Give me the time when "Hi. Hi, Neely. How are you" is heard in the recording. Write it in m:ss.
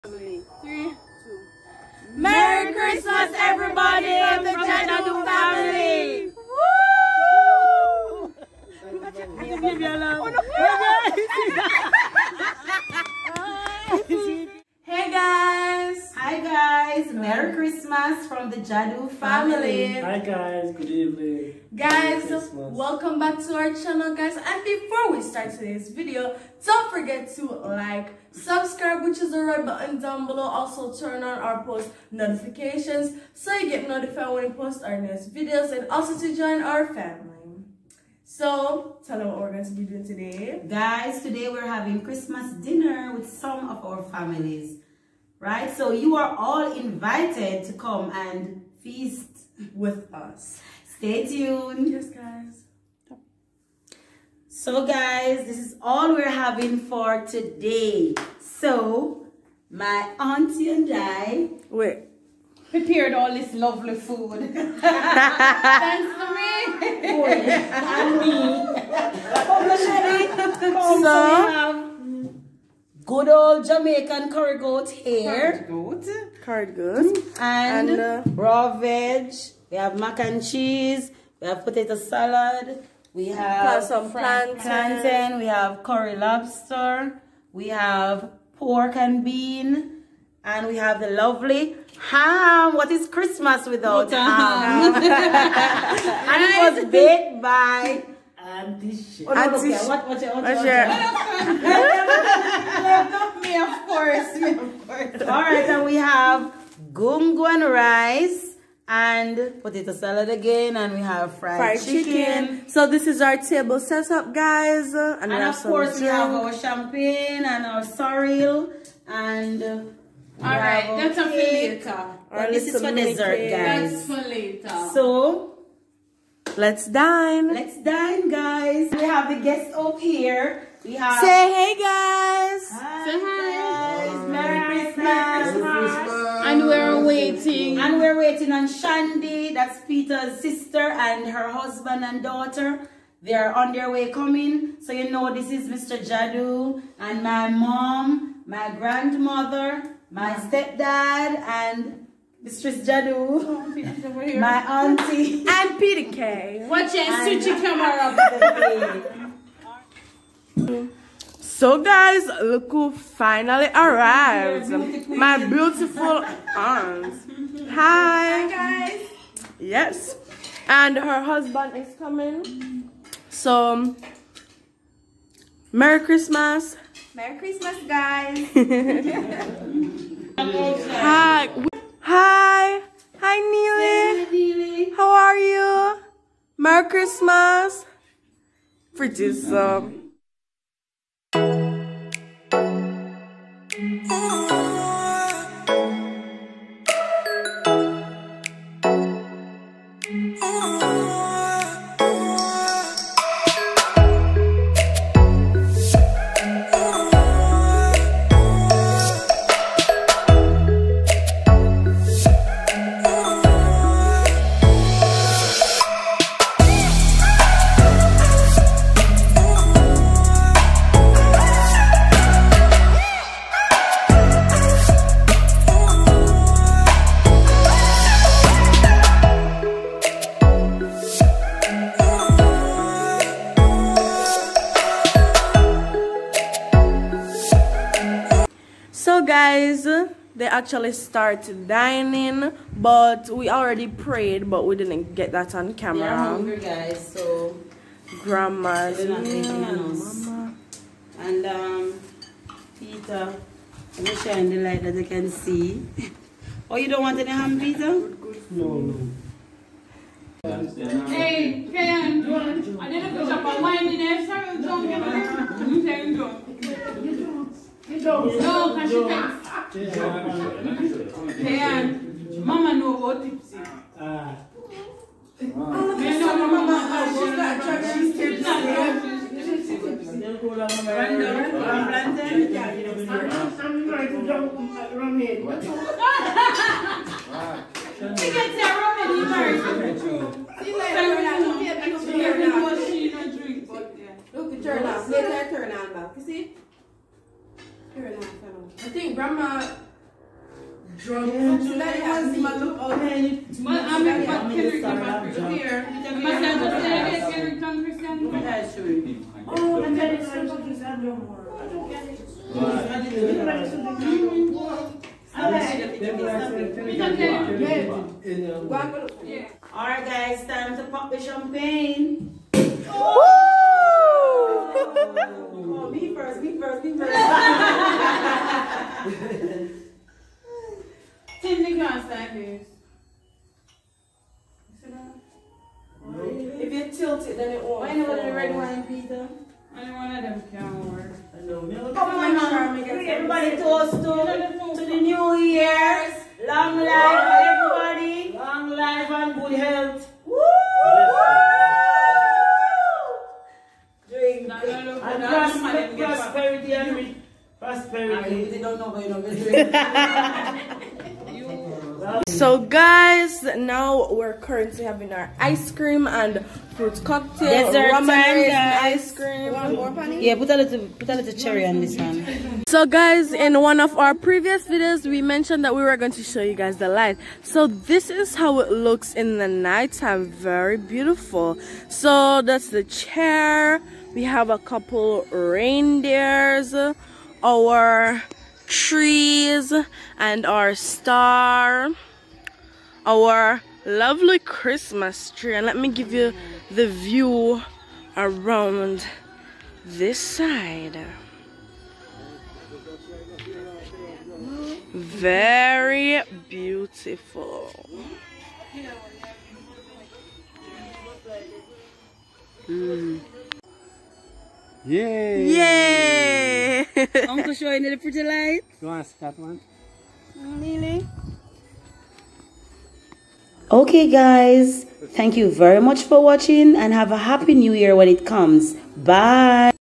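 3:02.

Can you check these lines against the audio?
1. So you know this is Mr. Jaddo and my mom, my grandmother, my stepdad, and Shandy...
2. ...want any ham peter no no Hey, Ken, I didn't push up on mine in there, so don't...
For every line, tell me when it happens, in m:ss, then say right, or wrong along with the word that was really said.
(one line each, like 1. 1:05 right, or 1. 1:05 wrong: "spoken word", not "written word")
1. 2:24 wrong: "Mistress", not "Shandy"
2. 4:17 right.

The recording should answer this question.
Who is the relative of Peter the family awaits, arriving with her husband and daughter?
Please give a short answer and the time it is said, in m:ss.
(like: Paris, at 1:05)
Shandy, at 2:18.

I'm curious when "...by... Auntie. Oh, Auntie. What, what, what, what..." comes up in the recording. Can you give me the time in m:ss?
1:37.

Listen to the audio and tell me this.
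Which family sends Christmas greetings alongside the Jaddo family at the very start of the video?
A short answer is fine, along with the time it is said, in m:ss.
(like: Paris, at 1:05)
Chinatown family, at 0:04.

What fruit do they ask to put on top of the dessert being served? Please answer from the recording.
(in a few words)
Cherry.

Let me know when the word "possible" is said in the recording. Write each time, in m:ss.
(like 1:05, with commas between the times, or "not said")
not said.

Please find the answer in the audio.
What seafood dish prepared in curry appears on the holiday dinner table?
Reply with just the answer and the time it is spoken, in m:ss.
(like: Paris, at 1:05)
Curry lobster, at 1:25.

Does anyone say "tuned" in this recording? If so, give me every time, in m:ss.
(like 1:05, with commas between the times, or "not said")
0:51.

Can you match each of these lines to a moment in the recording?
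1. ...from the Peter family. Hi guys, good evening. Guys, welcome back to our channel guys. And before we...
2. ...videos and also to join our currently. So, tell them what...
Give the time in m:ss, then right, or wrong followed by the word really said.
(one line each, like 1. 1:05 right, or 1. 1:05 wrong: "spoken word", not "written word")
1. 0:18 wrong: "Jaddo", not "Peter"
2. 0:35 wrong: "family", not "currently".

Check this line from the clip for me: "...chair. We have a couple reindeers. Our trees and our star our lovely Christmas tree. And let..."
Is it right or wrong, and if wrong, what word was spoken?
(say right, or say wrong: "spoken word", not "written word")
right.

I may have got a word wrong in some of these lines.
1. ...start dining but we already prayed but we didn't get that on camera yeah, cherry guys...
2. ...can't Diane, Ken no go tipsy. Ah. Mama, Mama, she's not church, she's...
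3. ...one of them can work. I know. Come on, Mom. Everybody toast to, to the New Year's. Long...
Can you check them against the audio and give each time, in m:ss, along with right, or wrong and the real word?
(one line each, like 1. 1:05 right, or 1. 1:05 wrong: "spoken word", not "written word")
1. 4:00 wrong: "hungry", not "cherry"
2. 4:29 wrong: "Mama", not "Ken"
3. 5:40 right.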